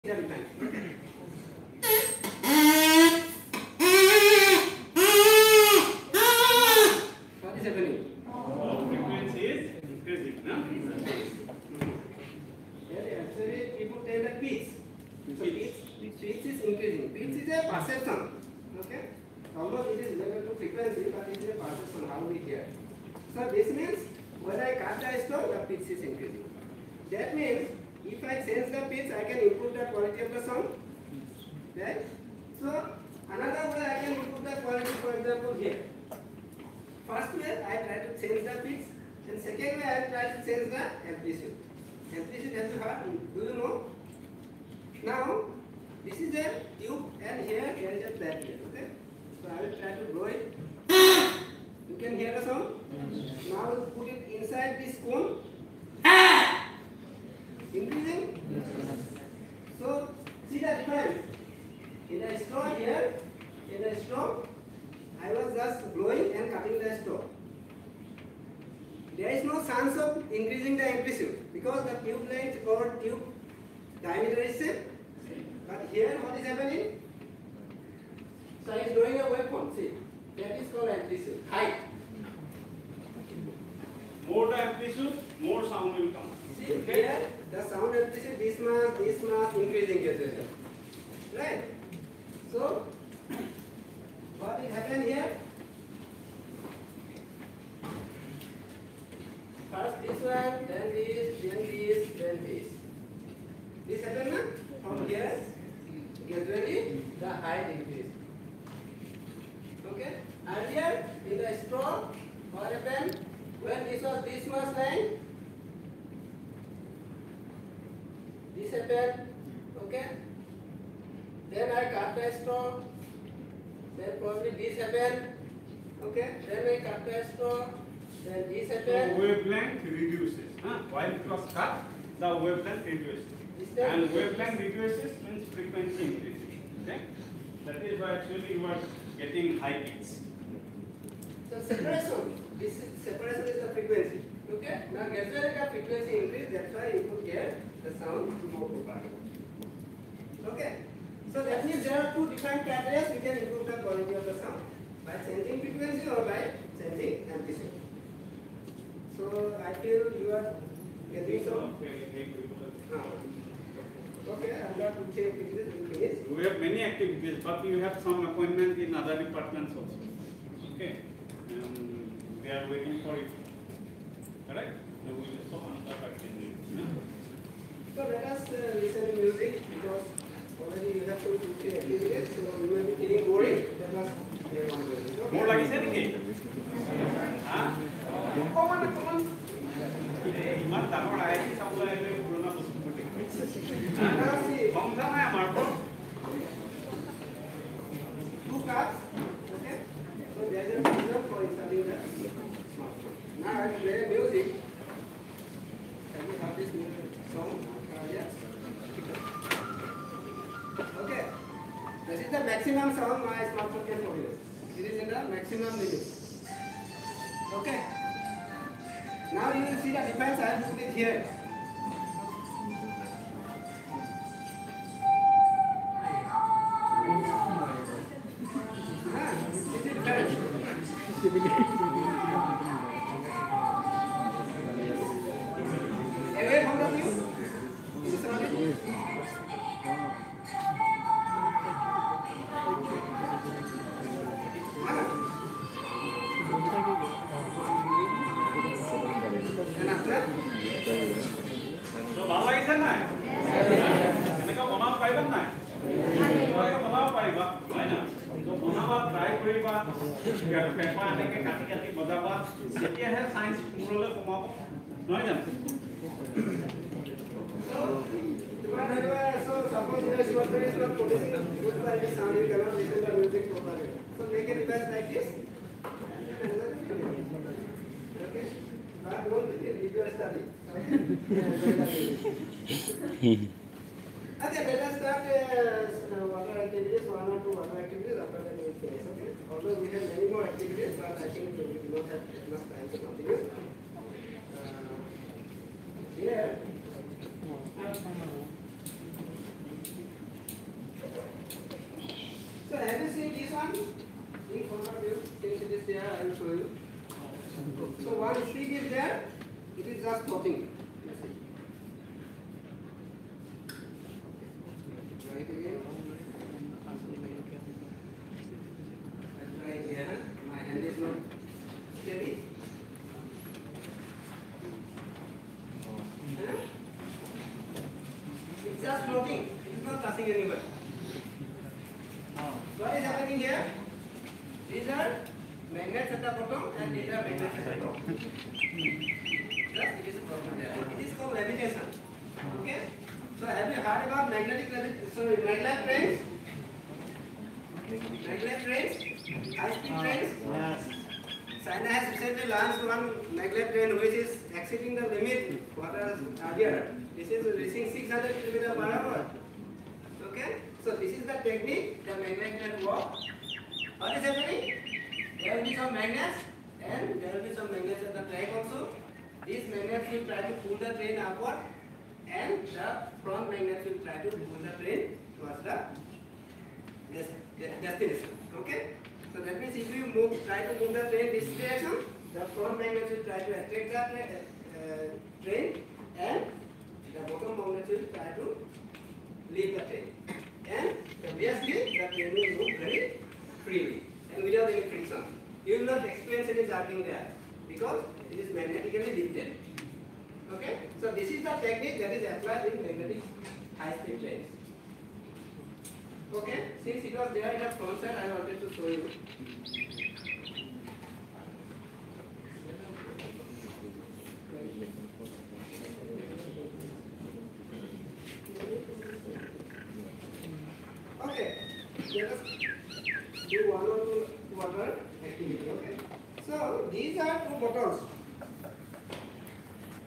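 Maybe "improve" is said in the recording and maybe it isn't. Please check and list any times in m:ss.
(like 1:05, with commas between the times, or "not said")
0:29, 0:34, 2:33.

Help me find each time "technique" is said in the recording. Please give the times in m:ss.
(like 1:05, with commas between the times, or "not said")
6:01, 6:41.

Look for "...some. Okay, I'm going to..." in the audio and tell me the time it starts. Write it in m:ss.
2:41.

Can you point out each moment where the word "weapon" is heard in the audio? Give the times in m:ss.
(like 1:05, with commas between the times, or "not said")
1:19.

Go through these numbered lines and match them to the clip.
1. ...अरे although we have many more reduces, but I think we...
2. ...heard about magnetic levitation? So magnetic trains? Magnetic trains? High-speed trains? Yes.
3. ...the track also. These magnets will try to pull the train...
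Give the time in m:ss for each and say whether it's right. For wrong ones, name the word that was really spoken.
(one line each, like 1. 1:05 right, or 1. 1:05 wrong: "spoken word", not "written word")
1. 4:44 wrong: "activities", not "reduces"
2. 5:43 right
3. 6:08 right.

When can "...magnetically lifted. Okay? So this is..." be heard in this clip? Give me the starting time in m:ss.
6:38.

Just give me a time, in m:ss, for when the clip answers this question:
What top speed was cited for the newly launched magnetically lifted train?
5:57.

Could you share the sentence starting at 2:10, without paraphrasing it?
While it was cut, the wavelength reduces.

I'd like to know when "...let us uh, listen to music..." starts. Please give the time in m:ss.
2:58.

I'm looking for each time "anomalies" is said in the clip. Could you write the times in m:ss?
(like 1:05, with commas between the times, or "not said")
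not said.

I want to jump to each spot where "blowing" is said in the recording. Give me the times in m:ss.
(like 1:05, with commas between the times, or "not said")
1:05.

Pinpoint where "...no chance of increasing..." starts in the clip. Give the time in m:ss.
1:09.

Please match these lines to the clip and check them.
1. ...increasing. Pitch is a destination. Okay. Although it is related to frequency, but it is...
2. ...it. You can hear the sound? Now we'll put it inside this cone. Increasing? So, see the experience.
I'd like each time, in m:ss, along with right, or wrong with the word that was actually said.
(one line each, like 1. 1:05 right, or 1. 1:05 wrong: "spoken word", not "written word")
1. 0:16 wrong: "perception", not "destination"
2. 0:50 wrong: "difference", not "experience".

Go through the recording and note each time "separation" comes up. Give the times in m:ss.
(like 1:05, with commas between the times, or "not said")
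2:21.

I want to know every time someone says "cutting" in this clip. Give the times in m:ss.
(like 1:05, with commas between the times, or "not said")
1:06.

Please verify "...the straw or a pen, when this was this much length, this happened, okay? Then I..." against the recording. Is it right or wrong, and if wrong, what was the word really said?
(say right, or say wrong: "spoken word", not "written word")
right.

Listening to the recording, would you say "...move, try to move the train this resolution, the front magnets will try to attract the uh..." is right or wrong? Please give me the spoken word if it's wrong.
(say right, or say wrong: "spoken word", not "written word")
wrong: "direction", not "resolution".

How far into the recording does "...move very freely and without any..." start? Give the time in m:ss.
6:32.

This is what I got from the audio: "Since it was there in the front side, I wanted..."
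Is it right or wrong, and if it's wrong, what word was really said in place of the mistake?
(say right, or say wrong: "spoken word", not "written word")
right.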